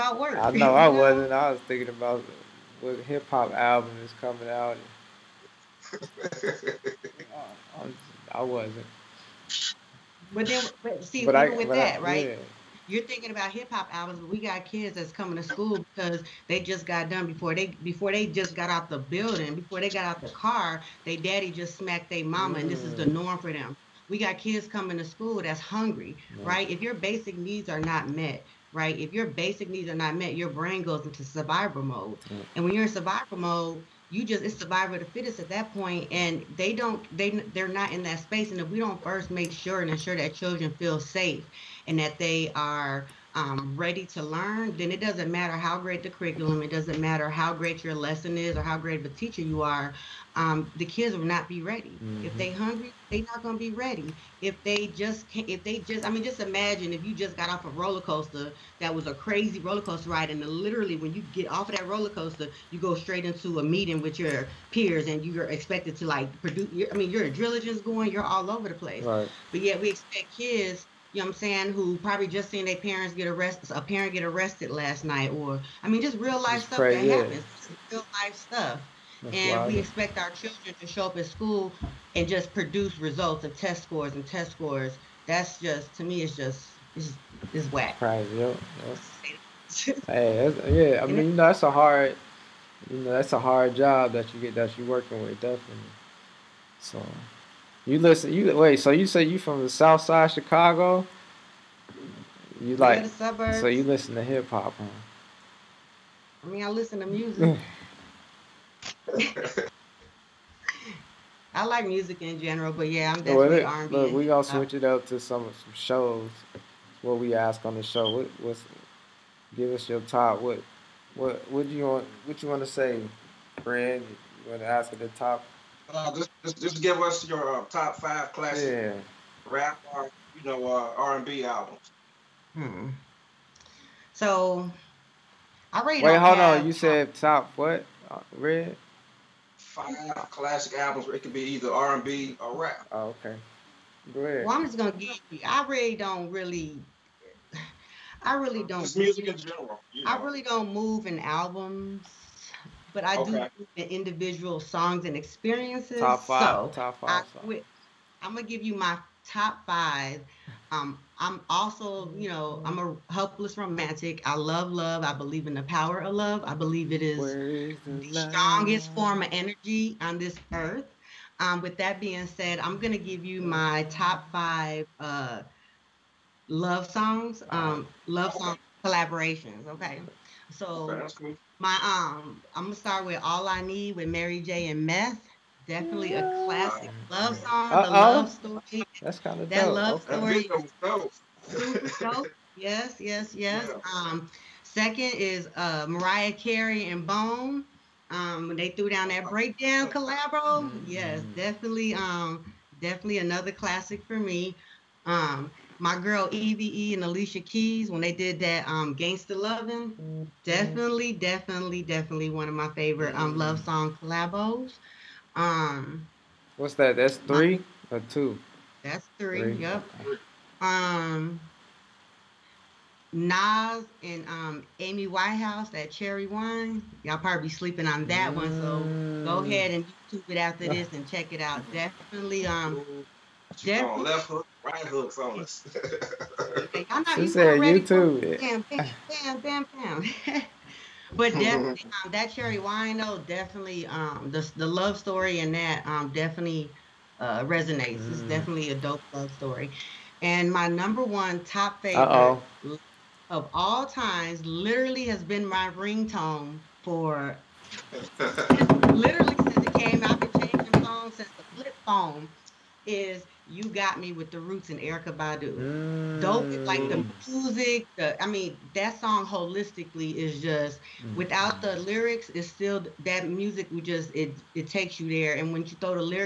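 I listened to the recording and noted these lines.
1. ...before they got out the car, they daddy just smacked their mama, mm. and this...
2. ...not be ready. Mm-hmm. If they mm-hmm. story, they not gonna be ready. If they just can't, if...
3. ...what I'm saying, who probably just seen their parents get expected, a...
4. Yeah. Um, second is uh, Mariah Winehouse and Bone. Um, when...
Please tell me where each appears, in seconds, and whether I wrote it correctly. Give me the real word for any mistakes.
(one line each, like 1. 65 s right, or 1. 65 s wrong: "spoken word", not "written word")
1. 19 s right
2. 51 s wrong: "hungry", not "story"
3. 71 s wrong: "arrested", not "expected"
4. 193 s wrong: "Carey", not "Winehouse".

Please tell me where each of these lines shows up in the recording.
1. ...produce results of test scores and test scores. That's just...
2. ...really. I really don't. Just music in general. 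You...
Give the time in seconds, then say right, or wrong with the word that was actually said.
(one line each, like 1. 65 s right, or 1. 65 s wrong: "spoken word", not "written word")
1. 82 s right
2. 146 s right.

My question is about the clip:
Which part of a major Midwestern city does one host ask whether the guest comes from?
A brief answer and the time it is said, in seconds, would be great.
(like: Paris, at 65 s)
South Side Chicago, at 99 s.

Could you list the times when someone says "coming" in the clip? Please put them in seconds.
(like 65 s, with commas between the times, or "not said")
4 s, 15 s, 24 s.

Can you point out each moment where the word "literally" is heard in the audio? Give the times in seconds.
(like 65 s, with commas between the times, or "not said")
60 s, 254 s, 258 s.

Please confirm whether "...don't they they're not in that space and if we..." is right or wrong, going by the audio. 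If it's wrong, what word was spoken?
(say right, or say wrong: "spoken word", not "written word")
right.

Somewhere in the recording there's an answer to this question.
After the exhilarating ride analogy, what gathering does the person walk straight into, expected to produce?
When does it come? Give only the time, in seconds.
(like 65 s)
63 s.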